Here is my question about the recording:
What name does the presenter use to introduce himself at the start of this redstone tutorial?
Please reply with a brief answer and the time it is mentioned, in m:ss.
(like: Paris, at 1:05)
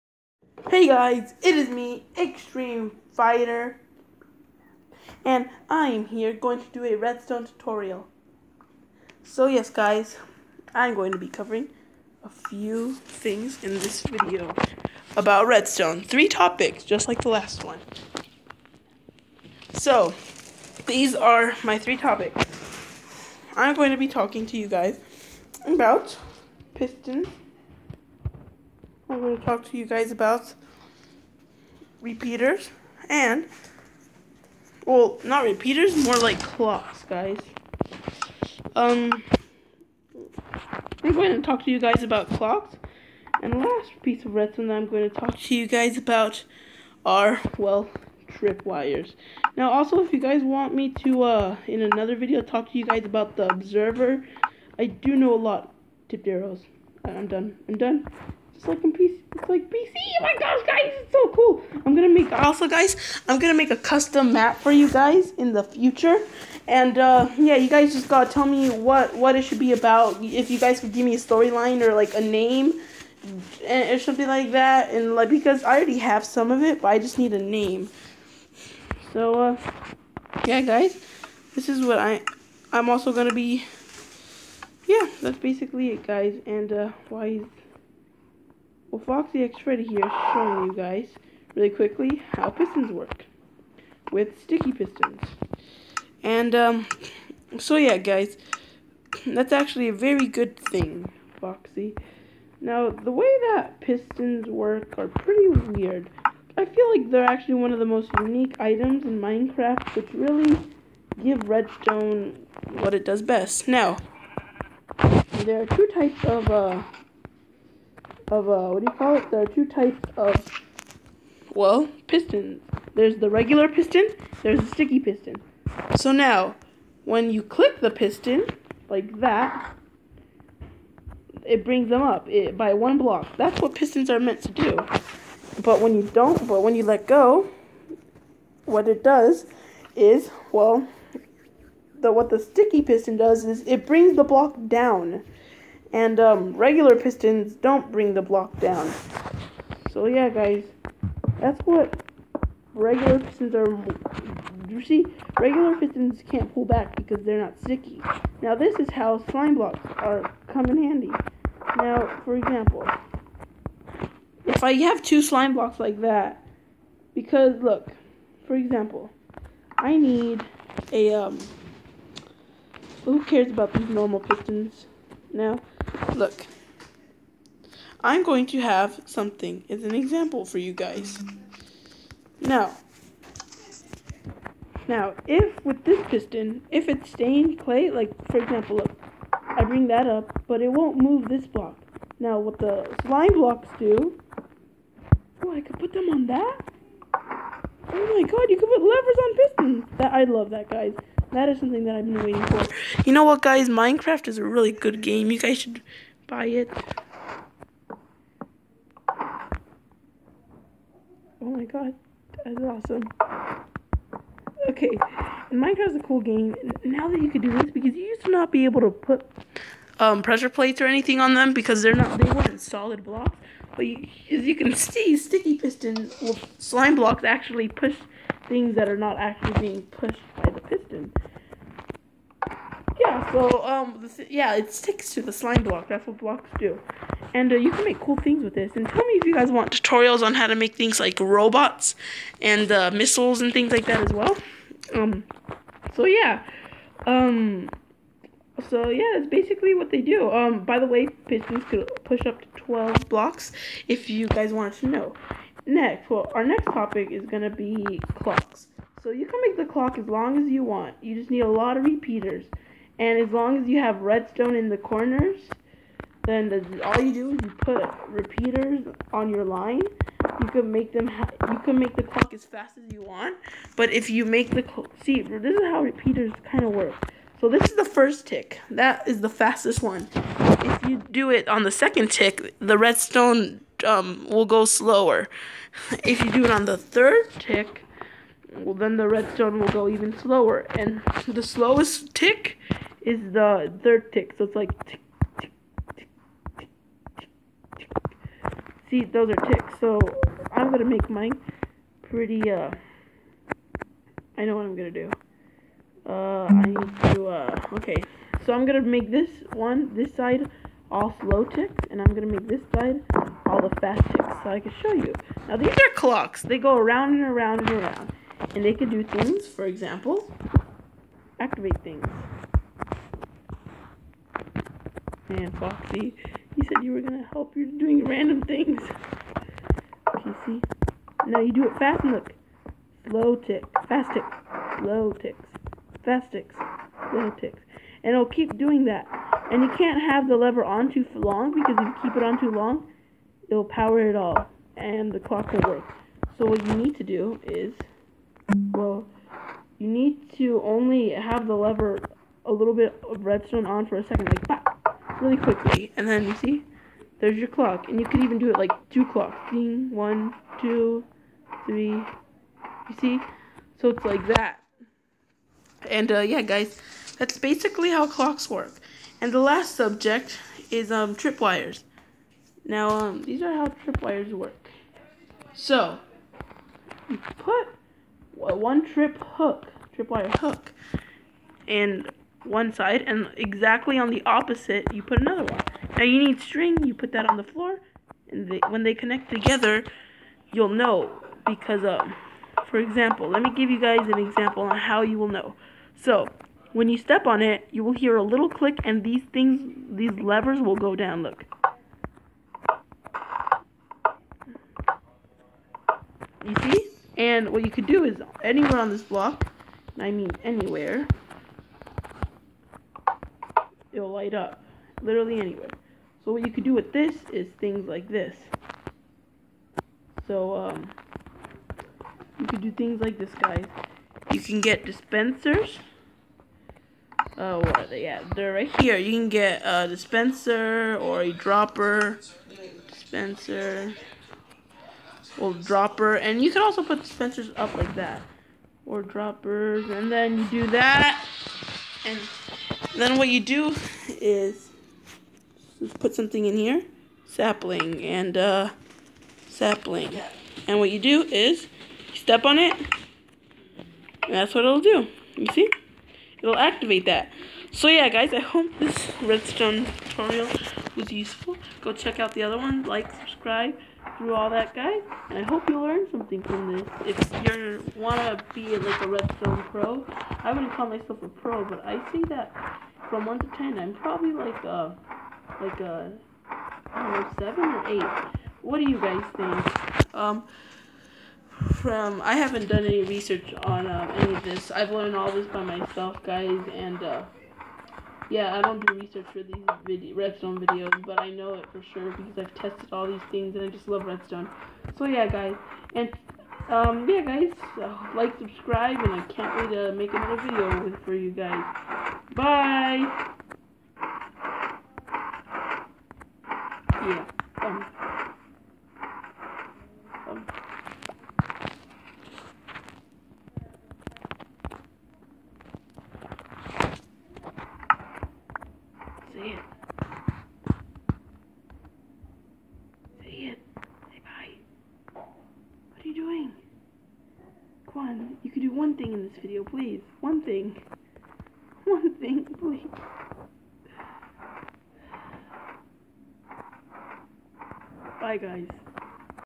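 Extreme Fighter, at 0:02.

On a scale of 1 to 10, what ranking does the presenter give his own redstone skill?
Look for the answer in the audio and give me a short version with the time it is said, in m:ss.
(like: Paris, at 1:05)
7 or 8, at 7:57.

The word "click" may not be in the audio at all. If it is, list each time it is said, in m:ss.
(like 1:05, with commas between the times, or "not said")
2:07, 6:38.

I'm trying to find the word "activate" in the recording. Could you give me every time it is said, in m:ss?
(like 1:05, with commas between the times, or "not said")
5:21, 7:36.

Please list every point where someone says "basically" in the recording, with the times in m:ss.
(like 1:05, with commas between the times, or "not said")
1:25, 4:09, 6:07.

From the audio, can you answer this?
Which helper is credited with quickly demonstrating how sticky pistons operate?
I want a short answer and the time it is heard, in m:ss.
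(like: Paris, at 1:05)
Foxy X Freddy, at 1:29.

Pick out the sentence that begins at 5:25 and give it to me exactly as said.
And Foxy, you said you were going to help.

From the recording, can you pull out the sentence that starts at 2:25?
And um, regular pistons don't bring the block down.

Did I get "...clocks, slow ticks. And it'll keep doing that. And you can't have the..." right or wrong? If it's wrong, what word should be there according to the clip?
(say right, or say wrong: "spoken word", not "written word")
wrong: "ticks", not "clocks".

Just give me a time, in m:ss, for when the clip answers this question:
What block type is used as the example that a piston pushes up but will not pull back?
3:07.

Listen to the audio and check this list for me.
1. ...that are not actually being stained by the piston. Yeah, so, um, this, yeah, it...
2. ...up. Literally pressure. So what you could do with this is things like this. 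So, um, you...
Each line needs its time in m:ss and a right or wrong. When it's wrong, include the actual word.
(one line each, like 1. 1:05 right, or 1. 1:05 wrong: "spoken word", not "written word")
1. 3:48 wrong: "pushed", not "stained"
2. 6:54 wrong: "anywhere", not "pressure".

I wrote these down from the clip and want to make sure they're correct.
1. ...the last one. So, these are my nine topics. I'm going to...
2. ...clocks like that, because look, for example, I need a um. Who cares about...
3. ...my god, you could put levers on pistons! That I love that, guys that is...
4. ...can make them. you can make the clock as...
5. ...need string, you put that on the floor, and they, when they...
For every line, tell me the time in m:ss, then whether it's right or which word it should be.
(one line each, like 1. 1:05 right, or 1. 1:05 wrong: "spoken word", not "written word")
1. 0:17 wrong: "three", not "nine"
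2. 2:45 wrong: "blocks", not "clocks"
3. 3:18 right
4. 4:30 right
5. 6:26 right.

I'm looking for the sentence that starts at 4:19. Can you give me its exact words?
So you can make the clock as long as you want.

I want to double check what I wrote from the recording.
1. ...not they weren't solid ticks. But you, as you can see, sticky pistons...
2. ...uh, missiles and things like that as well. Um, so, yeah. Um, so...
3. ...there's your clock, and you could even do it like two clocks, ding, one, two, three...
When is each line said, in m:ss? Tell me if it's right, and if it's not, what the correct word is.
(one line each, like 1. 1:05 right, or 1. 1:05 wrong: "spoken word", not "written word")
1. 3:41 wrong: "blocks", not "ticks"
2. 4:02 right
3. 5:57 right.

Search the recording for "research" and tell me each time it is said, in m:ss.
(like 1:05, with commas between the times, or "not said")
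8:03, 8:08.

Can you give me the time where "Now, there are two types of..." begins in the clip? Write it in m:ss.
1:53.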